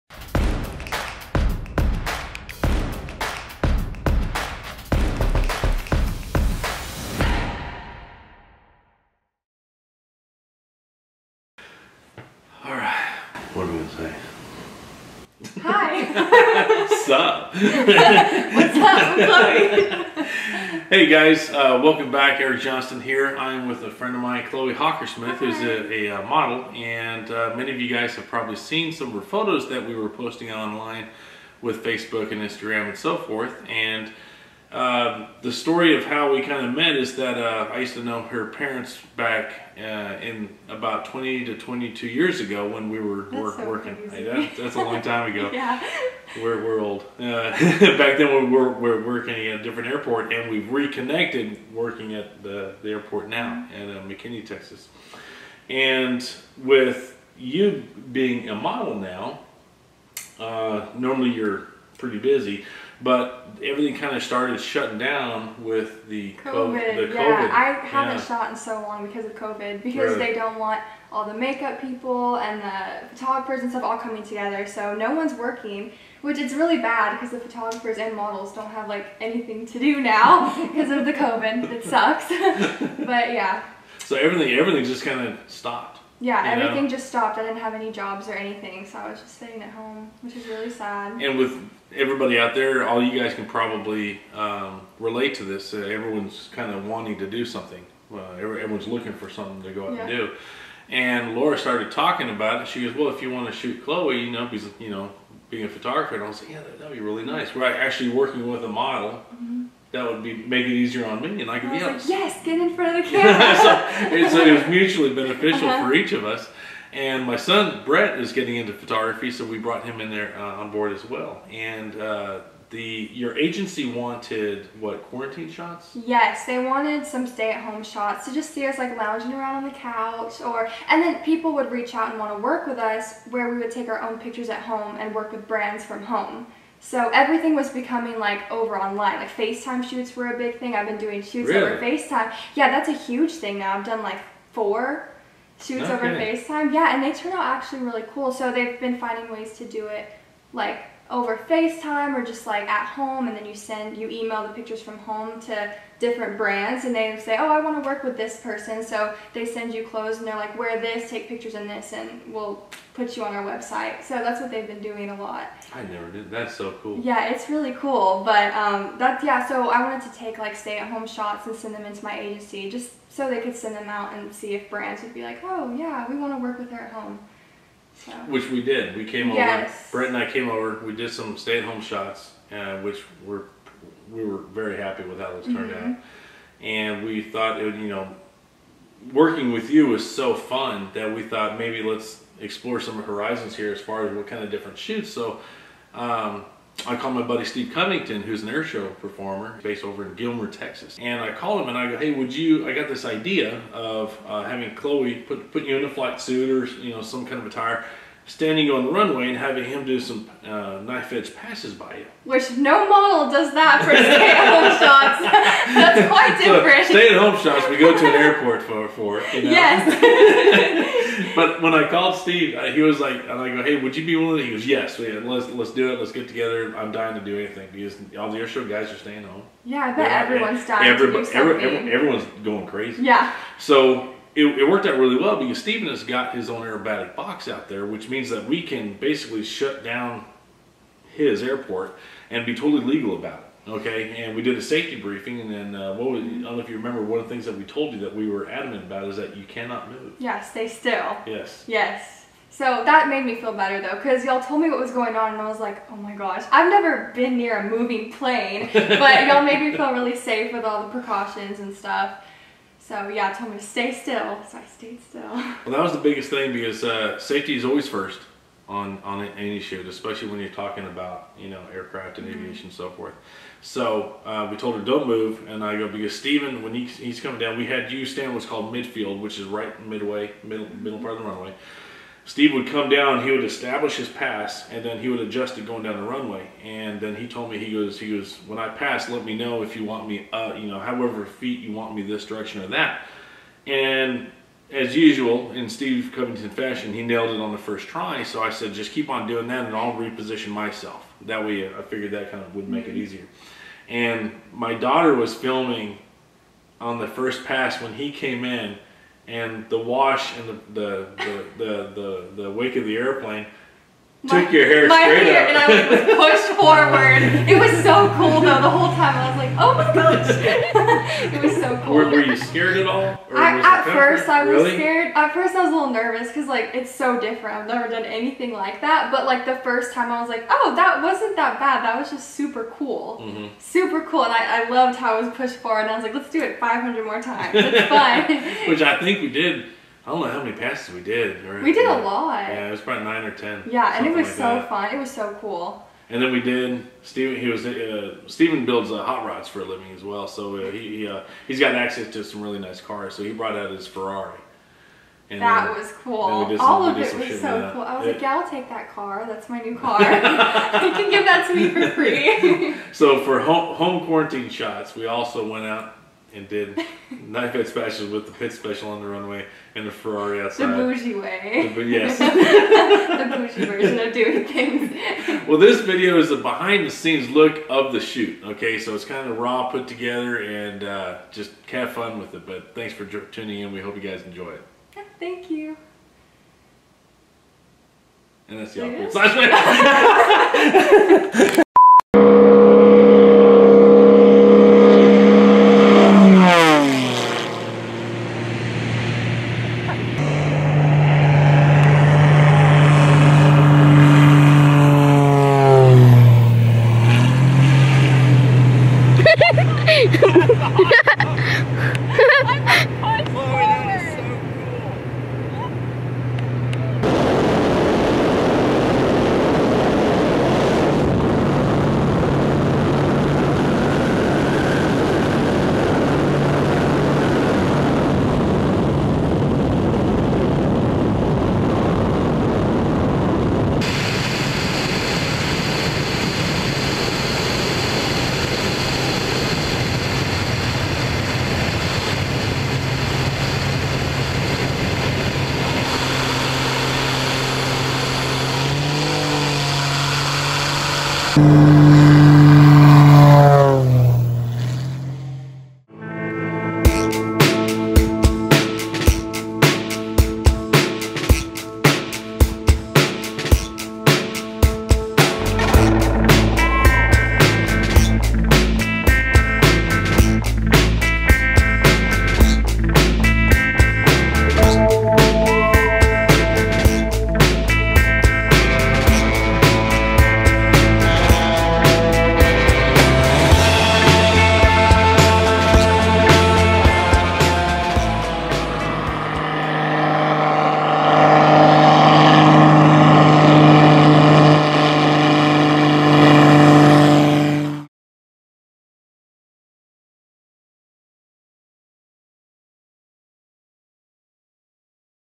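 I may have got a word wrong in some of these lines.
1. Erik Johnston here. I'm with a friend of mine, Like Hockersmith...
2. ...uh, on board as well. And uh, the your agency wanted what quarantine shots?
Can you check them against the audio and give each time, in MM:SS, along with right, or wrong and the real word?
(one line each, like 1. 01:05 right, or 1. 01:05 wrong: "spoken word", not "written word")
1. 00:22 wrong: "Chloe", not "Like"
2. 02:00 right.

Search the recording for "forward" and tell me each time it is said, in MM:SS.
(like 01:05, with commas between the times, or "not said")
05:16, 05:35.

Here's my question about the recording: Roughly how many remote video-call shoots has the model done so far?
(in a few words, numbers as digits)
4.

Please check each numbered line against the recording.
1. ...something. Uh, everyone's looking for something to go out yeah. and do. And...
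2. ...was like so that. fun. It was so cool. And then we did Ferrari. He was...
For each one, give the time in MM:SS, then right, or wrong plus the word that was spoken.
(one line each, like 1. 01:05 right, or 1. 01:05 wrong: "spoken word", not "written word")
1. 01:37 right
2. 05:44 wrong: "Stephen", not "Ferrari".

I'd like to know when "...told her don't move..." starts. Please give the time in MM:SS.
04:34.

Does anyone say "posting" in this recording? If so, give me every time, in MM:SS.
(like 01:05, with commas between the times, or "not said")
00:30.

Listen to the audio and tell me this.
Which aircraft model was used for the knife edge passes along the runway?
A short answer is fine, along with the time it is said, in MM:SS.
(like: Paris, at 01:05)
Pitts Special, at 06:08.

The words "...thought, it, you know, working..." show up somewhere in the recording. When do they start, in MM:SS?
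03:07.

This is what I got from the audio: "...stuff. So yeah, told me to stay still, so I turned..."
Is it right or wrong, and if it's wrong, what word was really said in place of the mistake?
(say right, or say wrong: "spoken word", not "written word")
wrong: "stayed", not "turned".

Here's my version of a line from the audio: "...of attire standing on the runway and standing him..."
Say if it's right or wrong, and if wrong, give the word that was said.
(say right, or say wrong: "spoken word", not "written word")
wrong: "having", not "standing".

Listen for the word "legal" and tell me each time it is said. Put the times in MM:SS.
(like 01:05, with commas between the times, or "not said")
04:02.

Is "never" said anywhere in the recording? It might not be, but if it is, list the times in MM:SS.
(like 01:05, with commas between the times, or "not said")
02:45, 04:16, 05:27.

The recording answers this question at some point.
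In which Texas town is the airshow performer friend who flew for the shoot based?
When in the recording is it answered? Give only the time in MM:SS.
03:20.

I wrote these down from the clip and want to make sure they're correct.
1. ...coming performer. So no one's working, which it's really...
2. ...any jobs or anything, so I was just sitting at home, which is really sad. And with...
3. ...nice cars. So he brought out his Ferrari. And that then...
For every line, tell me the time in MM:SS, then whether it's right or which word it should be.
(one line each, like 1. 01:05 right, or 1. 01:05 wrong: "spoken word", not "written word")
1. 01:13 wrong: "together", not "performer"
2. 01:27 right
3. 05:52 right.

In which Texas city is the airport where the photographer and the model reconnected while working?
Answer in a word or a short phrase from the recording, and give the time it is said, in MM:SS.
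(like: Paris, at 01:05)
McKinney, at 00:54.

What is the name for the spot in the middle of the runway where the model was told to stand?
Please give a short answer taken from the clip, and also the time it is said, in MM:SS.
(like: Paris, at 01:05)
midfield, at 04:38.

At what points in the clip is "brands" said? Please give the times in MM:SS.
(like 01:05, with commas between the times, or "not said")
02:15, 02:36, 02:54.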